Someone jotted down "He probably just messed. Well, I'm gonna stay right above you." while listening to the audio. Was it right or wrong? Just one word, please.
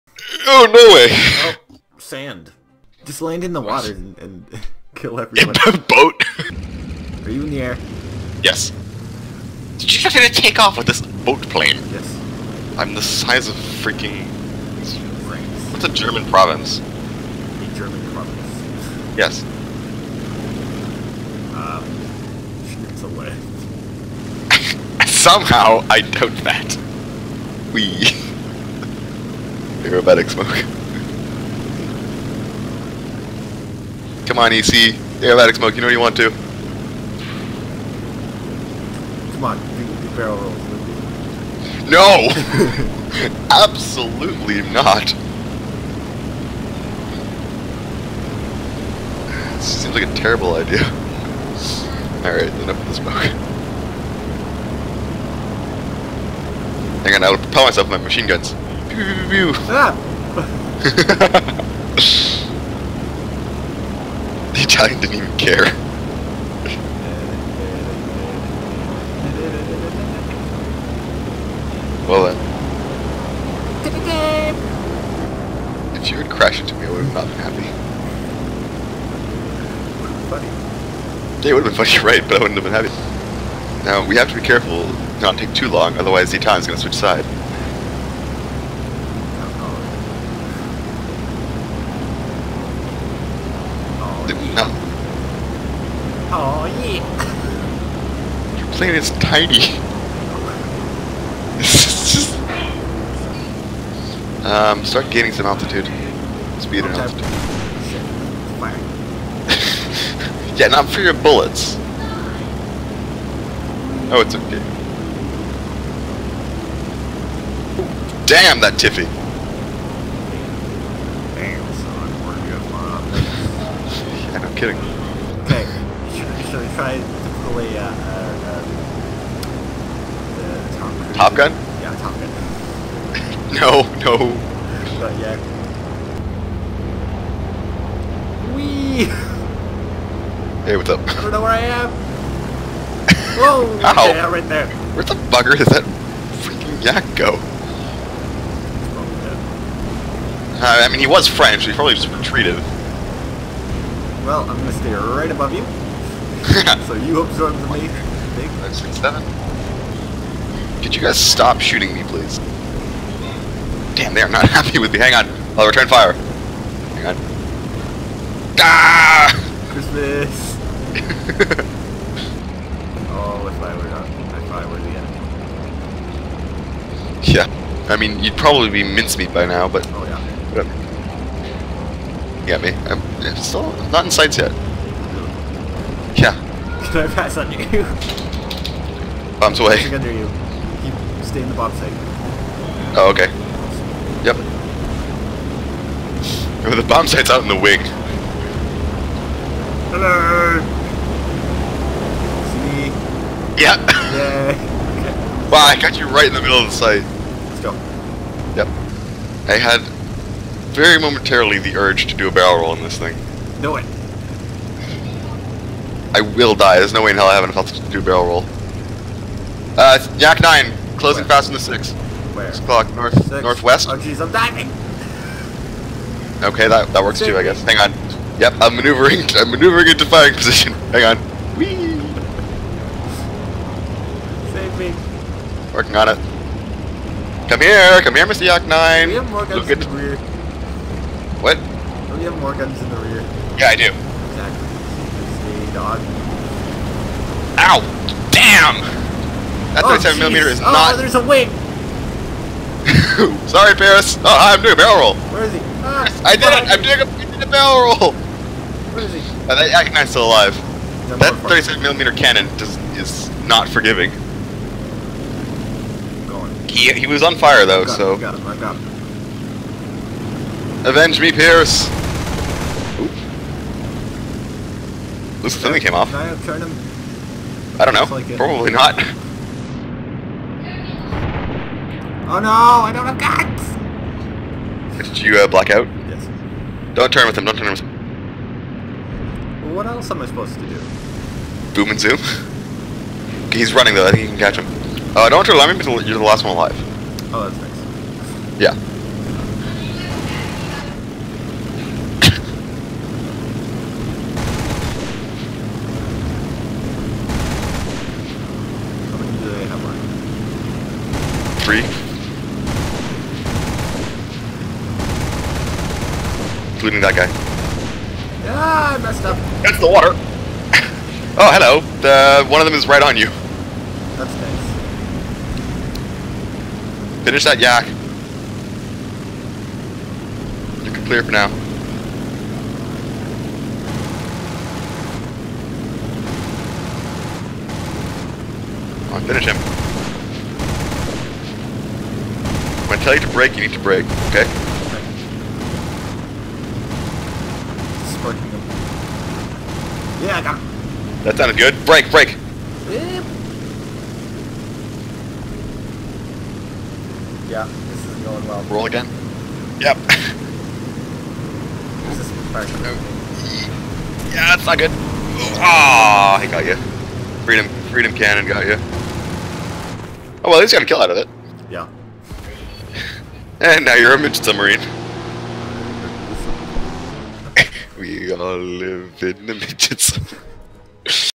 wrong.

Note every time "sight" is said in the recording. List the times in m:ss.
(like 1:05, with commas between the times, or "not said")
3:04, 3:11, 3:17, 3:26.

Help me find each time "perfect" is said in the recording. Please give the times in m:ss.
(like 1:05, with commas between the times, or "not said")
6:02.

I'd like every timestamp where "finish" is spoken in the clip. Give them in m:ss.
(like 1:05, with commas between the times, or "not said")
5:27, 5:39.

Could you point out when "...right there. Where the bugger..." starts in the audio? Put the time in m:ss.
2:24.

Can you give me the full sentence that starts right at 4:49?
Well, what else am I supposed to do?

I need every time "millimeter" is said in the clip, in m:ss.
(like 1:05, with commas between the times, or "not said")
4:10, 4:21.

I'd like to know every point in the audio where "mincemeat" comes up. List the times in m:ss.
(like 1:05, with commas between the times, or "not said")
2:58.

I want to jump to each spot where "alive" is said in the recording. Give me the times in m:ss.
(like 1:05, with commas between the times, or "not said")
4:20, 4:56.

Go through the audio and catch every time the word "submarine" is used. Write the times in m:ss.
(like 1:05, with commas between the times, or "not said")
6:14, 6:20.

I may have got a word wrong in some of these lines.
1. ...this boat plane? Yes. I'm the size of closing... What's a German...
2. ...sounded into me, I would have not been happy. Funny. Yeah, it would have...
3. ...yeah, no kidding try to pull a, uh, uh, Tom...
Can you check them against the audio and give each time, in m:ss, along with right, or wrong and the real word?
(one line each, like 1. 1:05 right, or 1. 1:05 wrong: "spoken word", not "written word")
1. 0:10 wrong: "freaking", not "closing"
2. 1:16 wrong: "crashed", not "sounded"
3. 2:04 right.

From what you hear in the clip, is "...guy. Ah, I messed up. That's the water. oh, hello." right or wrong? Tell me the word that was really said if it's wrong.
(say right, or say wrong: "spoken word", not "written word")
right.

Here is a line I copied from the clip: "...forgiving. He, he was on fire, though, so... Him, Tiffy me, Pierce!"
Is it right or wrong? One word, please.
wrong.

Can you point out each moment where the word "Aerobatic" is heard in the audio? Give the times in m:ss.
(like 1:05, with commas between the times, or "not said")
0:29, 0:35.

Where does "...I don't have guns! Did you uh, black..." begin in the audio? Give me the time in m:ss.
4:42.